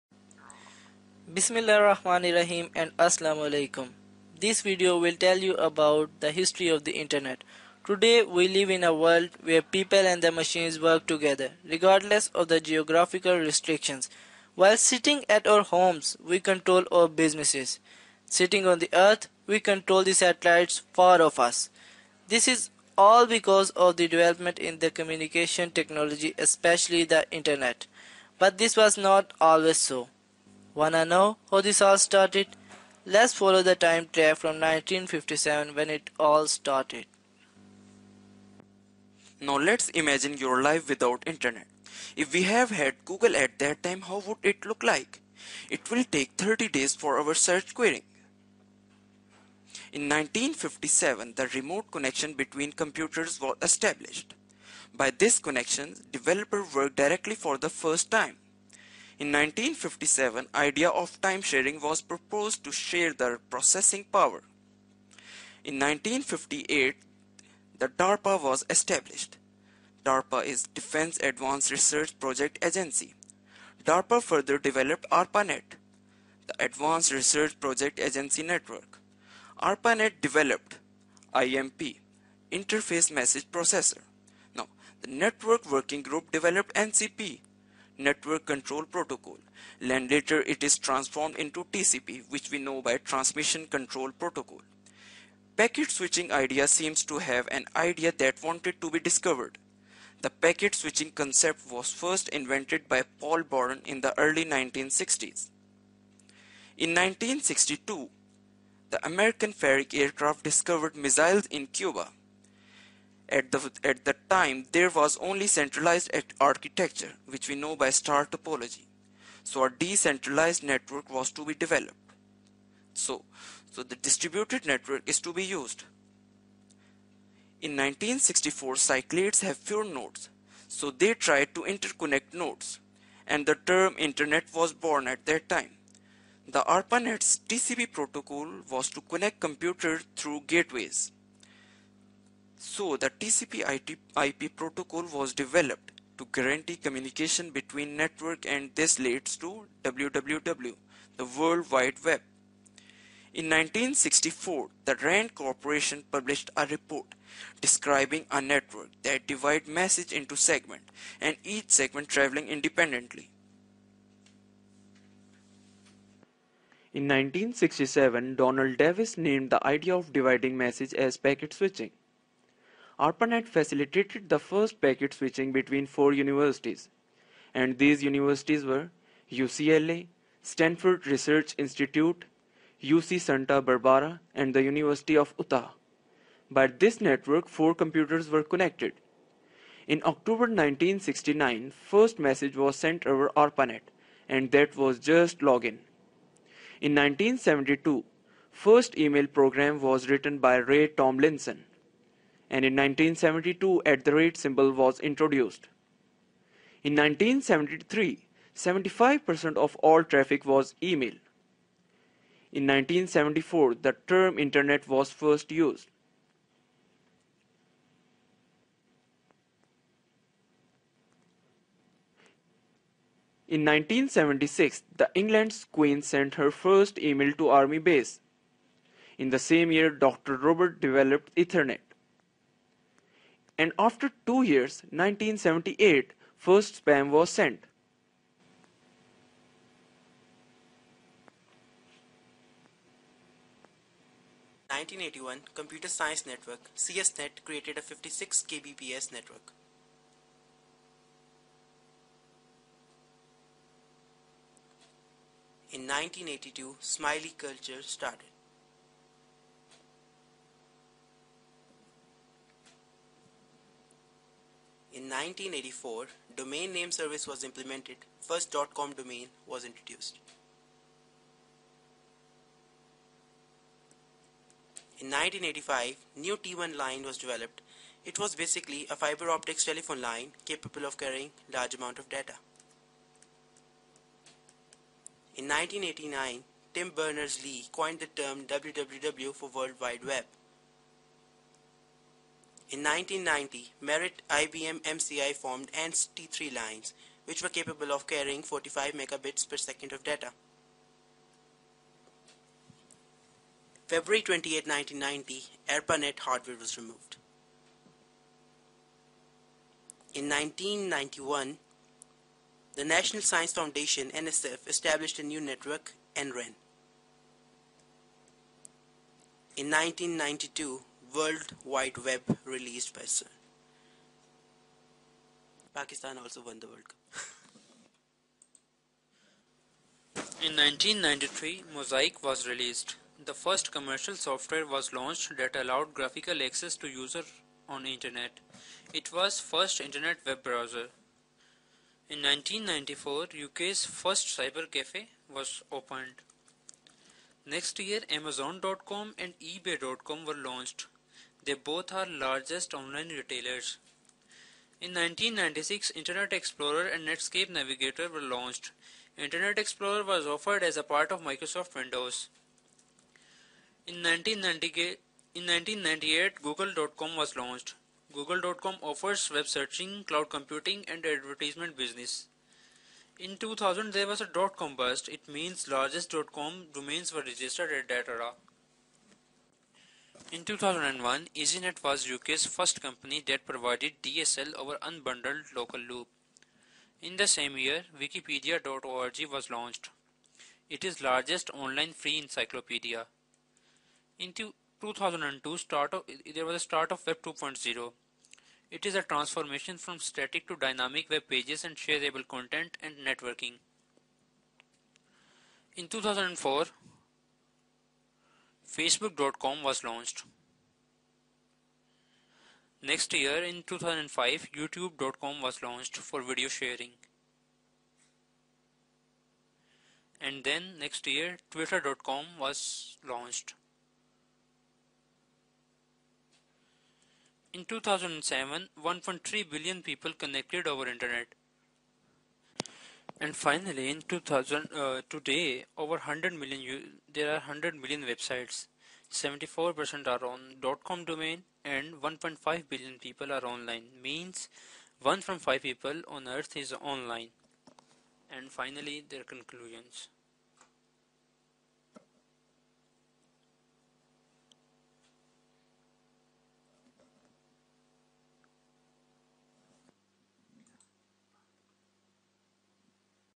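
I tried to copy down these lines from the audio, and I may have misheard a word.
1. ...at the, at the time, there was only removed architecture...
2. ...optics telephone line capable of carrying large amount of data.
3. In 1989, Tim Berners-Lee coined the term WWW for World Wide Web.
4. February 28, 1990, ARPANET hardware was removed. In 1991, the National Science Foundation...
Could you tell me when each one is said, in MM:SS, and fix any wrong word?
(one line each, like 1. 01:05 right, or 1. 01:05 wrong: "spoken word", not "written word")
1. 01:53 wrong: "centralized", not "removed"
2. 04:39 right
3. 04:45 right
4. 05:03 right.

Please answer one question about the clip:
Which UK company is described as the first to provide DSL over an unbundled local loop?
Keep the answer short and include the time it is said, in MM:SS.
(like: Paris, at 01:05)
EasyNet, at 06:21.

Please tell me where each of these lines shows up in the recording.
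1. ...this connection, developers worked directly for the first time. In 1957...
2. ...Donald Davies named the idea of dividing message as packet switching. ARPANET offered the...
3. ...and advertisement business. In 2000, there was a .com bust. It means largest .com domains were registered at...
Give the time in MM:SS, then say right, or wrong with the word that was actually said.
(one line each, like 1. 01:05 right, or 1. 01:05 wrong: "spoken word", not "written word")
1. 00:55 right
2. 02:48 wrong: "facilitated", not "offered"
3. 06:10 right.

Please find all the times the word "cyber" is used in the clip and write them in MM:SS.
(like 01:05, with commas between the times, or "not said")
05:44.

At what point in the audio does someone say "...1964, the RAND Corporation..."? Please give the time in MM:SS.
02:33.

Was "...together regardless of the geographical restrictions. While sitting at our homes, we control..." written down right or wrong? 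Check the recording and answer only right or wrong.
right.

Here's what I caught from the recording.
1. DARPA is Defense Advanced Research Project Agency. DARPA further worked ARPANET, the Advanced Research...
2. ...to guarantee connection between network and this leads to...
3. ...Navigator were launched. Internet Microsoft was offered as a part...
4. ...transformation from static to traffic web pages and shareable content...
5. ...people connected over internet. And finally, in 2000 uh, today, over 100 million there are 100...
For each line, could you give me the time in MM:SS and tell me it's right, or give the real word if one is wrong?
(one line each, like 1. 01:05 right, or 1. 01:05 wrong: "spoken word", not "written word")
1. 01:10 wrong: "developed", not "worked"
2. 02:26 wrong: "communication", not "connection"
3. 05:57 wrong: "Explorer", not "Microsoft"
4. 06:39 wrong: "dynamic", not "traffic"
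5. 07:09 right.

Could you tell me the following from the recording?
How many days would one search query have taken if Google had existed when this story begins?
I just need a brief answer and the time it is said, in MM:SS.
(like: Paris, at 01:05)
30 days, at 00:46.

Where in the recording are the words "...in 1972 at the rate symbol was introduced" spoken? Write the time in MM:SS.
03:22.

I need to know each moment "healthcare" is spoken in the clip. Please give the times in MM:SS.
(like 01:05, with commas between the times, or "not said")
not said.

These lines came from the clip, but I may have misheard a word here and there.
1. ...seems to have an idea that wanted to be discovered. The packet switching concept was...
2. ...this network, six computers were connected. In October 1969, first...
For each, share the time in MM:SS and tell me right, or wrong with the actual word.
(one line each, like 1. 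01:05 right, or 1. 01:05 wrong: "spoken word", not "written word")
1. 01:36 right
2. 03:06 wrong: "four", not "six".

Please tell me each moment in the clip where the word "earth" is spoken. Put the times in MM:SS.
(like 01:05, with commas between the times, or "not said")
00:18, 07:26.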